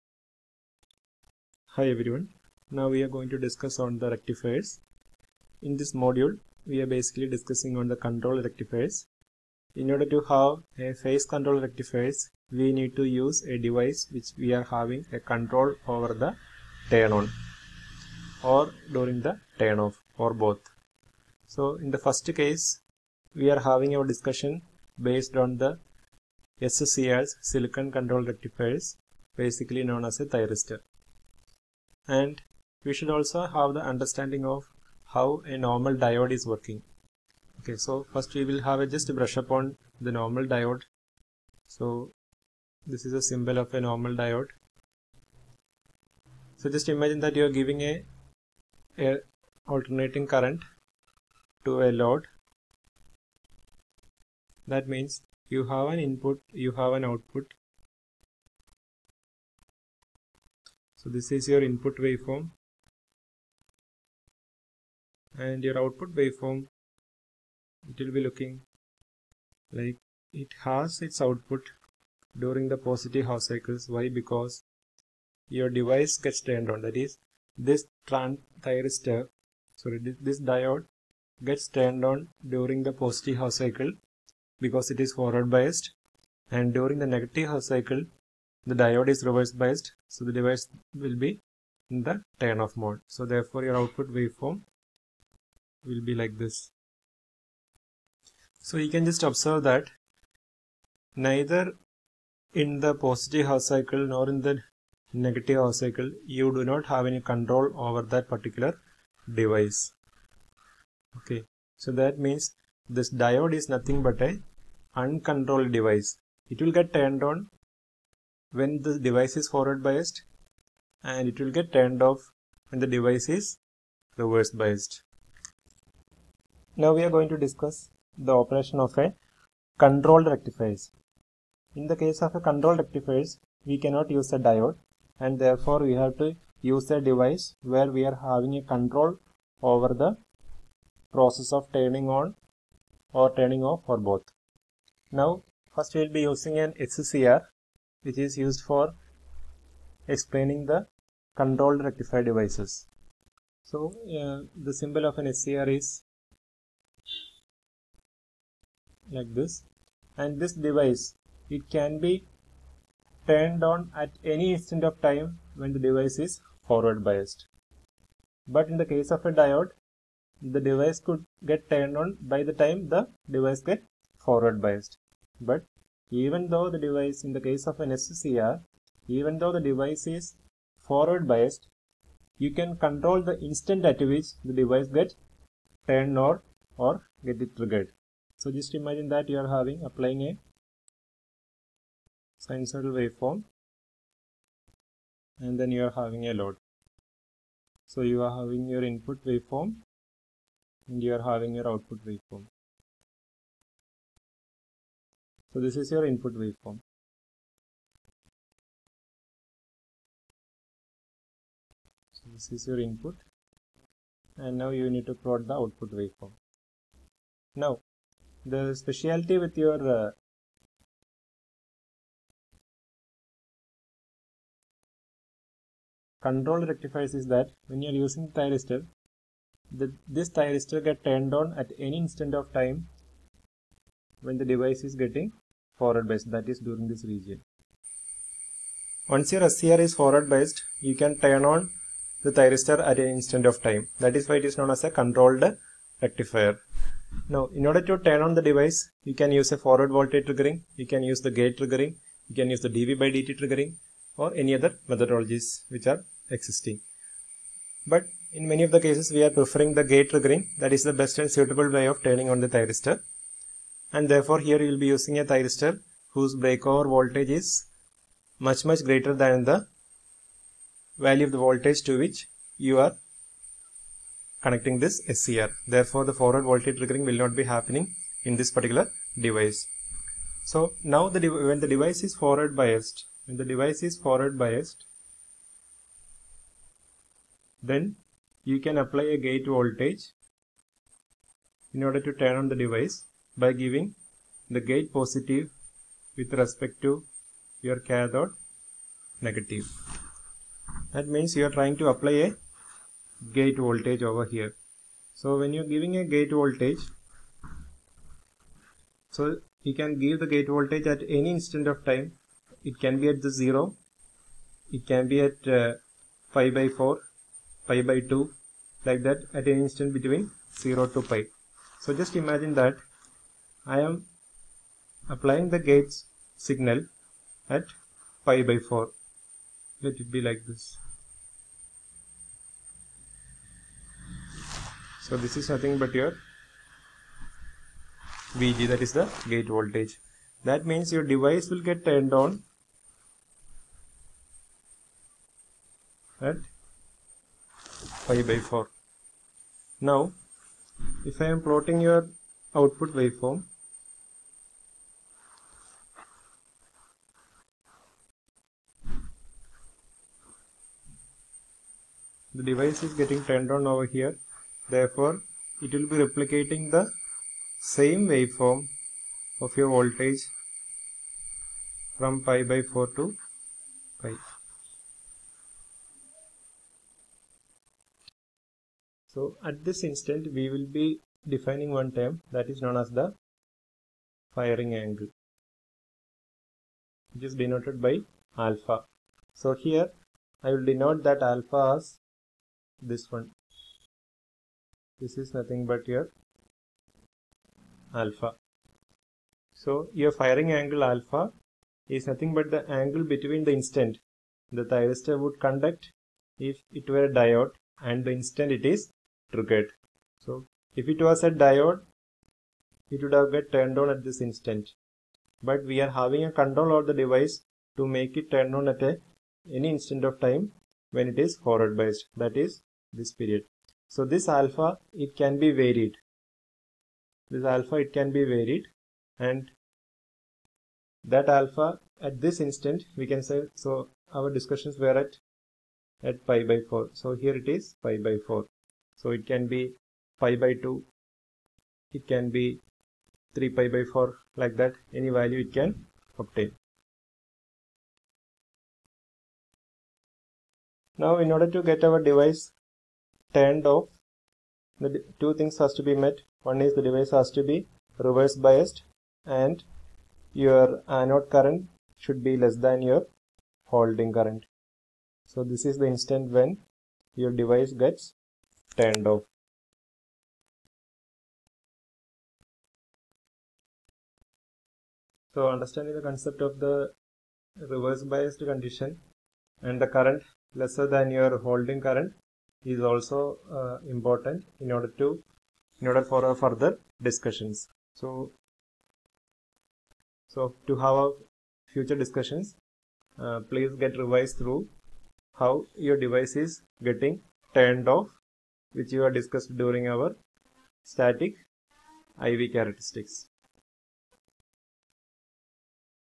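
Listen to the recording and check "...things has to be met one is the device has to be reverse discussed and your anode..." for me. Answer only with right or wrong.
wrong.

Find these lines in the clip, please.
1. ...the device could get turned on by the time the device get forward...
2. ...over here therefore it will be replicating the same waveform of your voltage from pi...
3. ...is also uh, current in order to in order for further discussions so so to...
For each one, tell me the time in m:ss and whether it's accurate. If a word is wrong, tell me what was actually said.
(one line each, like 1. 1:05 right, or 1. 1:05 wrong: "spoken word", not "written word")
1. 2:50 right
2. 6:03 right
3. 8:02 wrong: "important", not "current".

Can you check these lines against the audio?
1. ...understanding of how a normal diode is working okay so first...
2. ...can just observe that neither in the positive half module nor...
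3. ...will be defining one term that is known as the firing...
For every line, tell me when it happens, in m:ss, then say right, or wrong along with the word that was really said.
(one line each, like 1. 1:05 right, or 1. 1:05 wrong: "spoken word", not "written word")
1. 0:33 right
2. 1:38 wrong: "cycle", not "module"
3. 6:20 right.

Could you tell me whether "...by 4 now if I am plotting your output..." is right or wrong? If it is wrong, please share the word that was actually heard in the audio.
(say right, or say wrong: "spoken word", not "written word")
right.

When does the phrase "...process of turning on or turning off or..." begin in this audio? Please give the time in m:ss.
2:21.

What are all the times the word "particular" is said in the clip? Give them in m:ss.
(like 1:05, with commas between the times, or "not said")
1:48, 4:38.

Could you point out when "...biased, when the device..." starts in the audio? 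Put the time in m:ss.
4:42.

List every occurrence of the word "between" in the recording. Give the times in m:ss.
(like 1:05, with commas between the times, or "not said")
5:19, 6:43.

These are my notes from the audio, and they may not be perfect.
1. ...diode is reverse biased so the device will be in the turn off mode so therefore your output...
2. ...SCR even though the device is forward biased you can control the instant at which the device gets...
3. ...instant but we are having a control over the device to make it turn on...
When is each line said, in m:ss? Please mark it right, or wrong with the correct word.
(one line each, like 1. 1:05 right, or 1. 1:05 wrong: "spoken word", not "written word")
1. 1:28 right
2. 2:57 right
3. 6:54 right.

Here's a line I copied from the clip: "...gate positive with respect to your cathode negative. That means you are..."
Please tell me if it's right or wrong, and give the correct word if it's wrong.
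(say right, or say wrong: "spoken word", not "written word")
right.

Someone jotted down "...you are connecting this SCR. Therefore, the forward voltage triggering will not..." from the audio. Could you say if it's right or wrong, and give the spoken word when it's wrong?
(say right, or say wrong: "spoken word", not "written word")
right.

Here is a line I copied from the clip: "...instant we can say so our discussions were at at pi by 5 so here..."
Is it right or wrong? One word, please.
wrong.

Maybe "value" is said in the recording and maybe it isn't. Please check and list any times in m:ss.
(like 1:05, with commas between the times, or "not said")
4:31, 7:25.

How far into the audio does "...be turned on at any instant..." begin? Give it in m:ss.
2:41.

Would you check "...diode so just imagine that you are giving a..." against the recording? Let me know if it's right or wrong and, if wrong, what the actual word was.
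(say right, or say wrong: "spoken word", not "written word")
right.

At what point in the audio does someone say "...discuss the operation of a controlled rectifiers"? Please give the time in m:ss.
2:07.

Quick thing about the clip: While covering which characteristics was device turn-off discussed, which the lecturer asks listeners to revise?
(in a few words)
static IV characteristics.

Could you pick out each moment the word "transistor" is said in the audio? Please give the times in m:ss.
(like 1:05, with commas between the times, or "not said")
1:18.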